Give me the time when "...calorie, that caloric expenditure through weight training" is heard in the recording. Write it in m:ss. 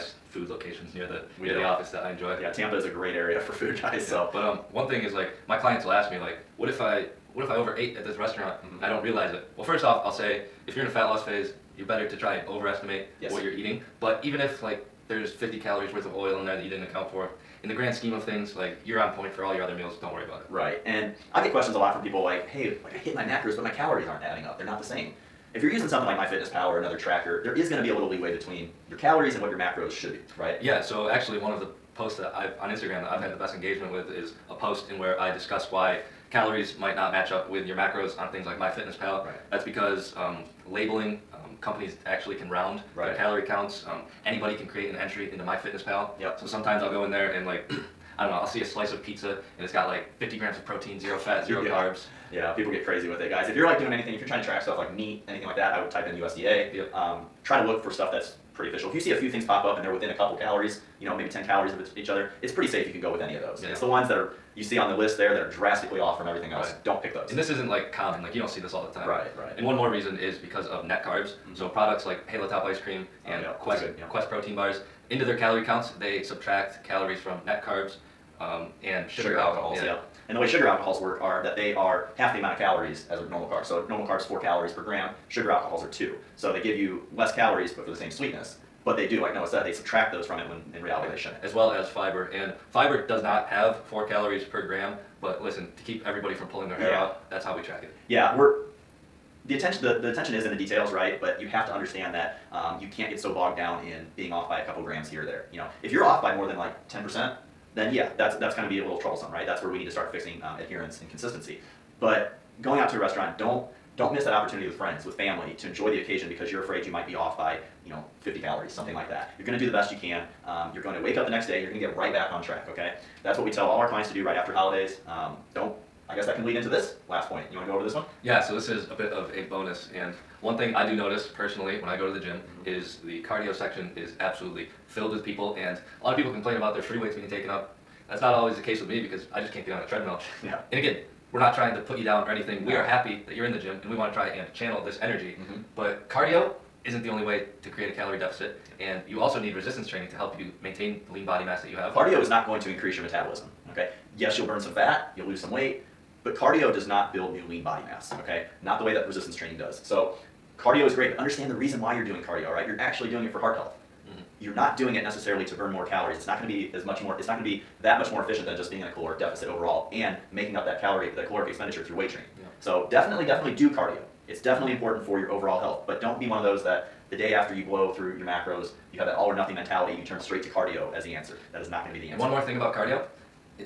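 2:50.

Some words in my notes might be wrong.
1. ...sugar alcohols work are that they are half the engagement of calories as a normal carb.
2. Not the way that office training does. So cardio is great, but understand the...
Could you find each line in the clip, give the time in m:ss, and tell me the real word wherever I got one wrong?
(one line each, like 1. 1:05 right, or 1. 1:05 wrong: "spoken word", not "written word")
1. 1:20 wrong: "amount", not "engagement"
2. 2:38 wrong: "resistance", not "office".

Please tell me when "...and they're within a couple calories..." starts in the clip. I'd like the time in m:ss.
0:59.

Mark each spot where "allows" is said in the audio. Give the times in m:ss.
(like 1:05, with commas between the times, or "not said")
not said.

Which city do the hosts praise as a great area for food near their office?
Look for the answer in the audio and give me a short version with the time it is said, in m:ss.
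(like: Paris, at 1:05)
Tampa, at 0:02.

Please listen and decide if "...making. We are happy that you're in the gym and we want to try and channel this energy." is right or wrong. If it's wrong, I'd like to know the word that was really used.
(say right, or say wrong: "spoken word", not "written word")
wrong: "anything", not "making".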